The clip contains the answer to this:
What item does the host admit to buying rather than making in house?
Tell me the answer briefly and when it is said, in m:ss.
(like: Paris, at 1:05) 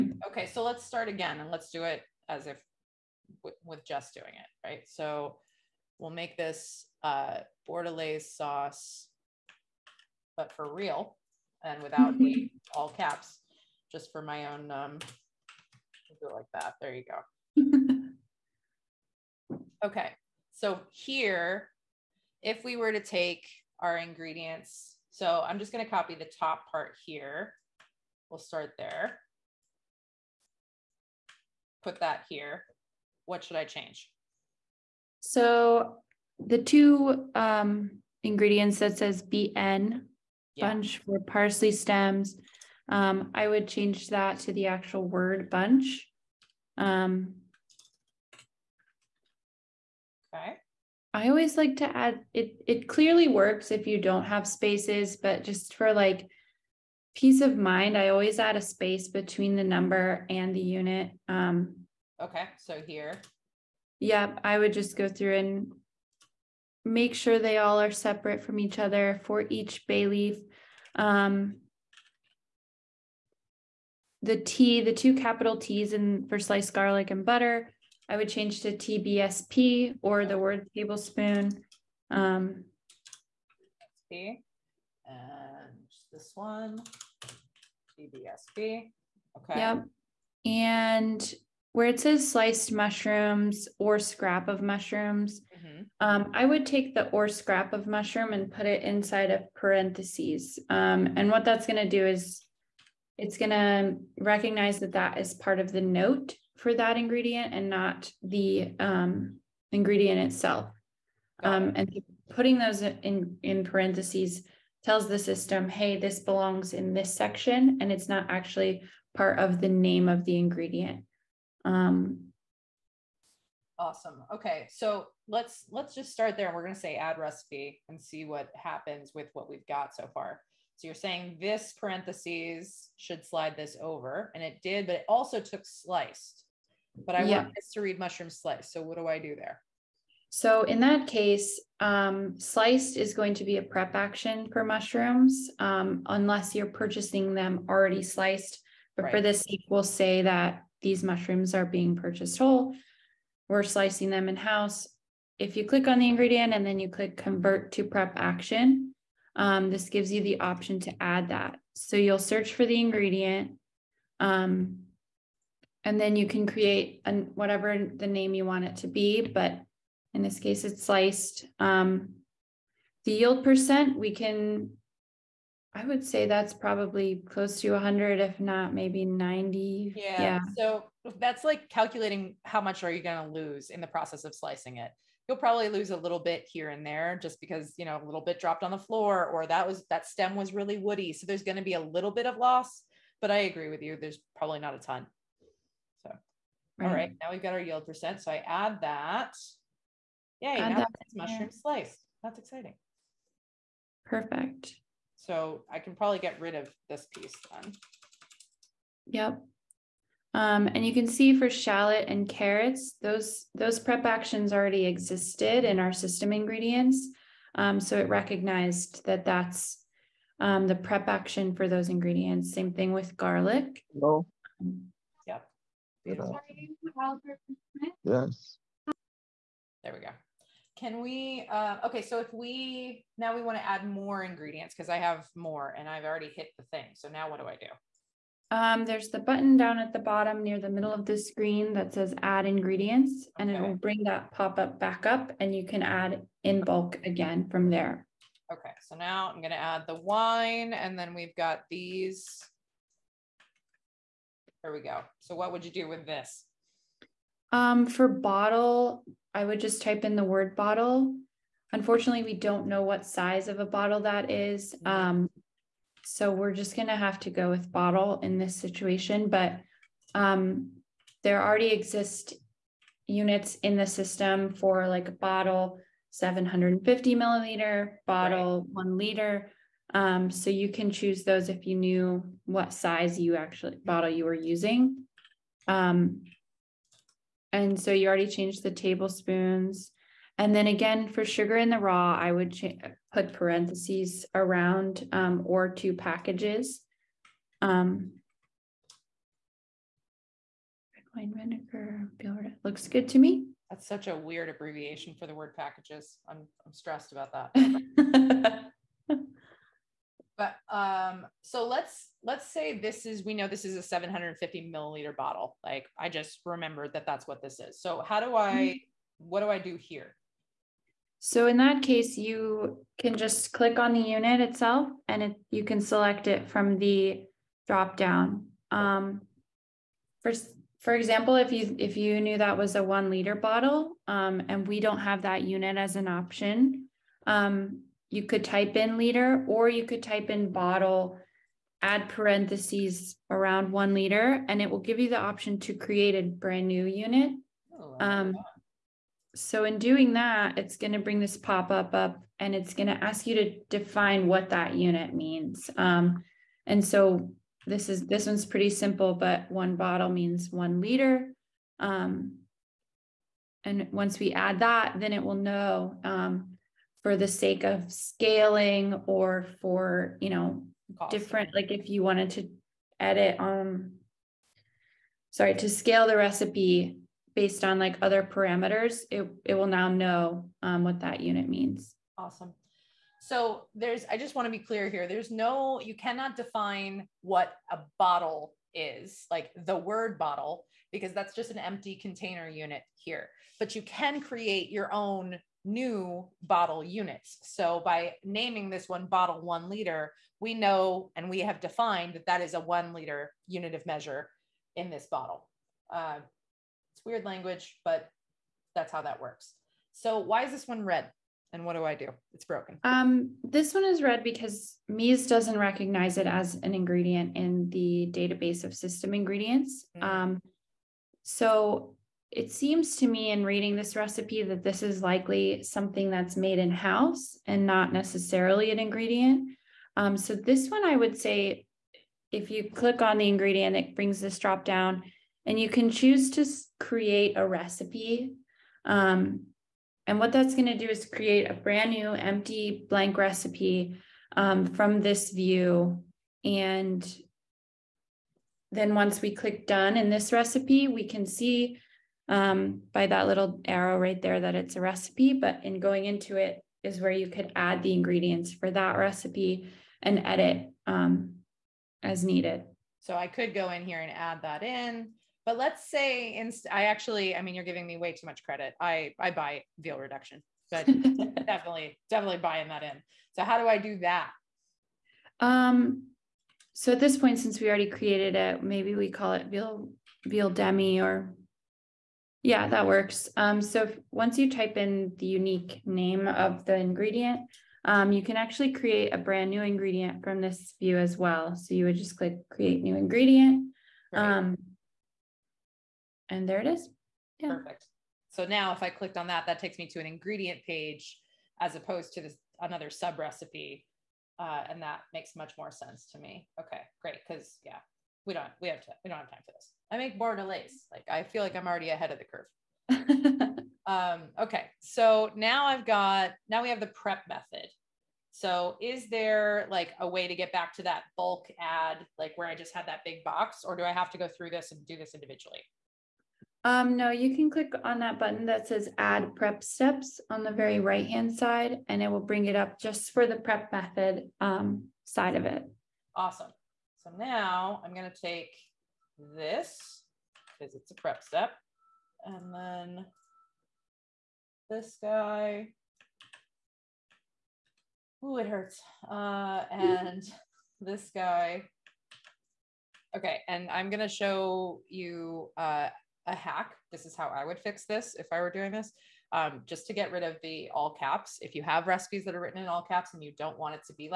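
veal reduction, at 7:49.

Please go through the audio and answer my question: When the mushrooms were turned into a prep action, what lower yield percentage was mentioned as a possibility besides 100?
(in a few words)
90.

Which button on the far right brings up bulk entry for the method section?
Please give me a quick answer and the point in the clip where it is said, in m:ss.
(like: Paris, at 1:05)
Add prep steps, at 8:48.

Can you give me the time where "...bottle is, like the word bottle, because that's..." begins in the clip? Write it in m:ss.
6:27.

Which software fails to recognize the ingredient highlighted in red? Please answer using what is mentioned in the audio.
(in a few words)
meez.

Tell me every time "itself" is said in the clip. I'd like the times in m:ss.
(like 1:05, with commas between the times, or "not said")
1:50, 5:24.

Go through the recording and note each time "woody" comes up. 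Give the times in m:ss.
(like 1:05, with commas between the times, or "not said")
3:10.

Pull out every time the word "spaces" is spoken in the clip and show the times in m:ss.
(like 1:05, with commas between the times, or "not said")
0:54, 0:58.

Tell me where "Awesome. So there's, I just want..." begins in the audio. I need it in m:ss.
6:22.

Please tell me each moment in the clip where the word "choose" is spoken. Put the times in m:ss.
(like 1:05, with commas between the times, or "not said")
4:40, 7:15.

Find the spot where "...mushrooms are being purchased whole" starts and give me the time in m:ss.
2:31.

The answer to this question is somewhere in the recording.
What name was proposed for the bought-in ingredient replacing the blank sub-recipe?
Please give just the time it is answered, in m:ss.
8:00.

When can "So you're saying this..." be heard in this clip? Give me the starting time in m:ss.
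2:10.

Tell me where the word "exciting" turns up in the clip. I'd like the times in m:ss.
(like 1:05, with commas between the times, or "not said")
3:22.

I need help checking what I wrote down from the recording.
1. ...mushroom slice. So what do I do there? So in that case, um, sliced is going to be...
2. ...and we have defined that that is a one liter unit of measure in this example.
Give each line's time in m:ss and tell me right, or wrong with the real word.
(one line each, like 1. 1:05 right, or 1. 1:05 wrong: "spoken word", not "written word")
1. 2:17 right
2. 6:41 wrong: "bottle", not "example".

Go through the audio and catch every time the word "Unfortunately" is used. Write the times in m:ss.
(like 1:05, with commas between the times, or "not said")
4:21.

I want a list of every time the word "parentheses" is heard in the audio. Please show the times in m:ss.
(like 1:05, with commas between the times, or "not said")
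1:39, 1:53, 2:11, 4:53, 5:42.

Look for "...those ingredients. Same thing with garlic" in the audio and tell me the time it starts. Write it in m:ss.
3:41.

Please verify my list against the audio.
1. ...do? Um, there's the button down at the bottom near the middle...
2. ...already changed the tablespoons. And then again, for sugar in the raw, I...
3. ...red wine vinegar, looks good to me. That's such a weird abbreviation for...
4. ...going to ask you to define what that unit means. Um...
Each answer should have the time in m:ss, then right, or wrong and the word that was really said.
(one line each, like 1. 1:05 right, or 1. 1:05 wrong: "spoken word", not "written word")
1. 3:57 right
2. 4:48 right
3. 5:00 right
4. 5:52 right.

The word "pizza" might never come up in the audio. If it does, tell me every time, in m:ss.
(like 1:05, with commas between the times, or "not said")
not said.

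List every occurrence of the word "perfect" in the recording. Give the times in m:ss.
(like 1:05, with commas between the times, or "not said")
3:24, 8:17.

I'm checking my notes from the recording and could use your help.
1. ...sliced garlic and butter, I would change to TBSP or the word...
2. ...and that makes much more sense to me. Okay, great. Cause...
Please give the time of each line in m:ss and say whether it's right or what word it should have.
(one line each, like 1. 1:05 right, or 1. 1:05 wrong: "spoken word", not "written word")
1. 1:16 right
2. 8:24 right.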